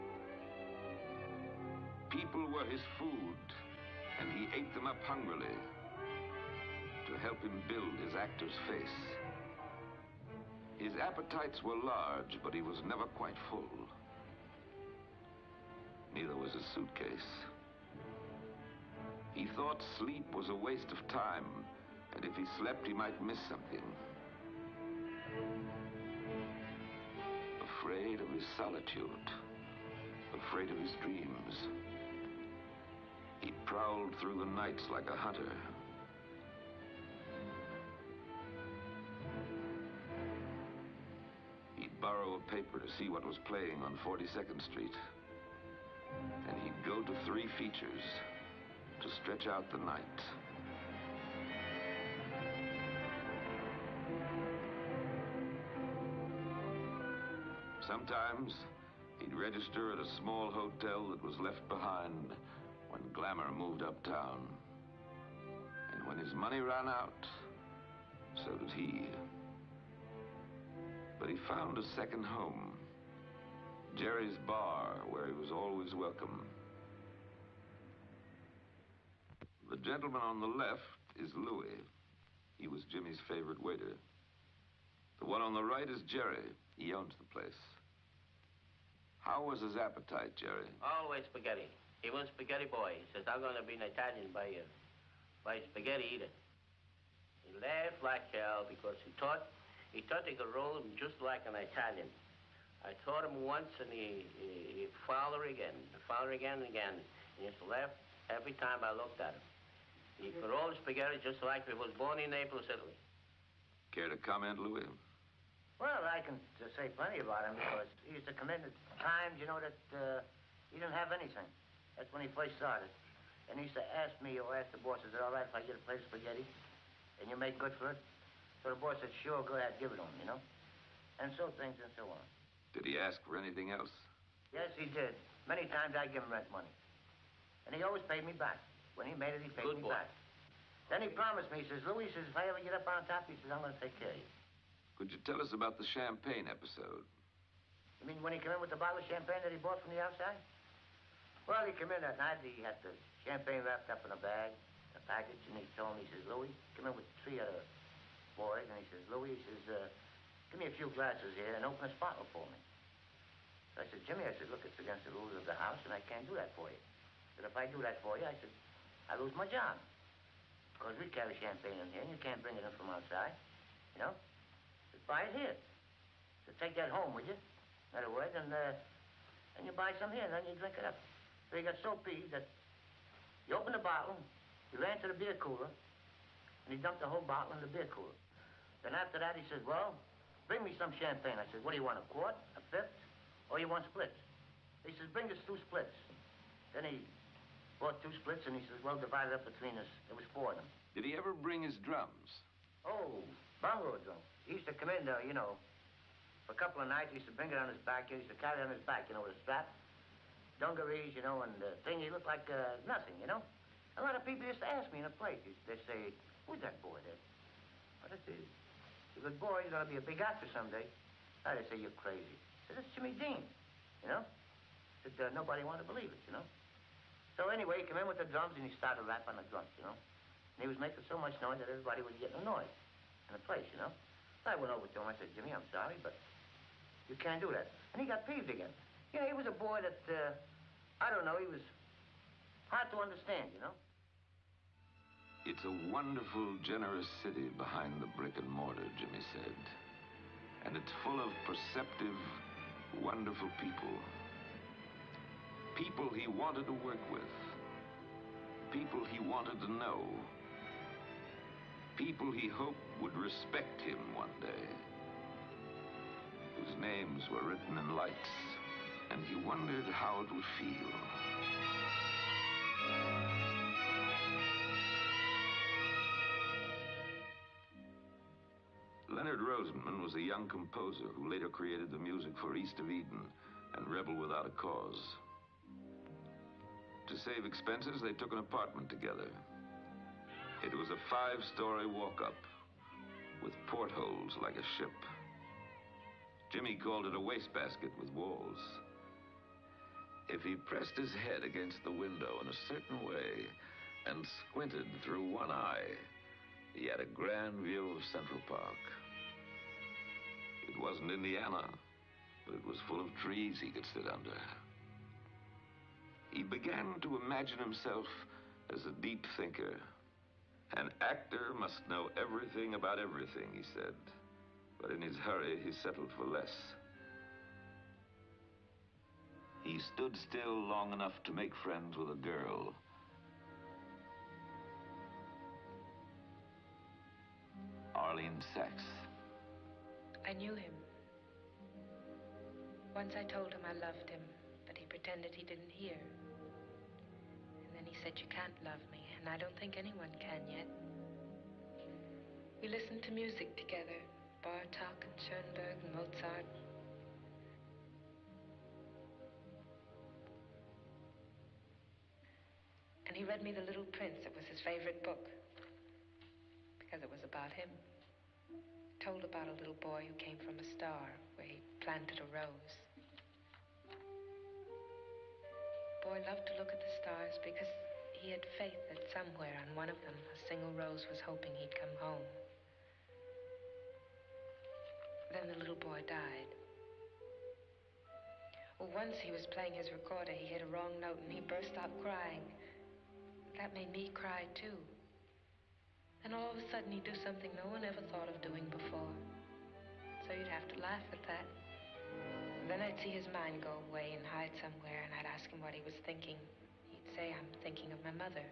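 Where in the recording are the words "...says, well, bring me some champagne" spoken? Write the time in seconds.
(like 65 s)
189 s.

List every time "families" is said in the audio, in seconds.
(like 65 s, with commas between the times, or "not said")
not said.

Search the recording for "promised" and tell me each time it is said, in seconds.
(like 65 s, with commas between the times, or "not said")
141 s.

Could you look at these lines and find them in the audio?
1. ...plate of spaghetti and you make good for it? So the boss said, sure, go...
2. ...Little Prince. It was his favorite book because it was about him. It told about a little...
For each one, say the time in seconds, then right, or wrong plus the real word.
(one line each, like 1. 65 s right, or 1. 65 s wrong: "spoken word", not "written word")
1. 125 s right
2. 363 s right.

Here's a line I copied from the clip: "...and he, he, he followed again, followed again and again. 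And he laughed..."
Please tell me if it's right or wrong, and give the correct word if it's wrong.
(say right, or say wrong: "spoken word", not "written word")
right.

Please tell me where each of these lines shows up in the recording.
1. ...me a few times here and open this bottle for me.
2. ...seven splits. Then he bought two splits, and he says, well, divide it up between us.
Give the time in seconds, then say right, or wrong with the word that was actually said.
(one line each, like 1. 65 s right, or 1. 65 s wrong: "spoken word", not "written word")
1. 160 s wrong: "glasses", not "times"
2. 195 s wrong: "two", not "seven".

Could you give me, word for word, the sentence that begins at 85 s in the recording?
The one on the right is Jerry.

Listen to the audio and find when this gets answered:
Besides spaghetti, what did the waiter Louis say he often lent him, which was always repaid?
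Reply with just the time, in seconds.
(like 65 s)
136 s.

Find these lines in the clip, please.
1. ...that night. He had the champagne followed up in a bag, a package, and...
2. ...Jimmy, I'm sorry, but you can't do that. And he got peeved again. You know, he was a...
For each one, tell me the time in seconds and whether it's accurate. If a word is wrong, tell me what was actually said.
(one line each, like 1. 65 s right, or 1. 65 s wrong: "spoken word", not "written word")
1. 152 s wrong: "wrapped", not "followed"
2. 235 s right.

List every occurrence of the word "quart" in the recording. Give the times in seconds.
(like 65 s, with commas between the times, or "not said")
192 s.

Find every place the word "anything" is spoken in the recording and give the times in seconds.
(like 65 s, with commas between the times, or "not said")
121 s, 133 s.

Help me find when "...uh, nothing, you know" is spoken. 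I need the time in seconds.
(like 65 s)
212 s.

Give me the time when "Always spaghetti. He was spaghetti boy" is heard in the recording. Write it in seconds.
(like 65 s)
90 s.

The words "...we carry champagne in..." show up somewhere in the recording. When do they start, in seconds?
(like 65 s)
170 s.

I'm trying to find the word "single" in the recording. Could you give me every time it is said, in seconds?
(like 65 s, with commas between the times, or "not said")
380 s.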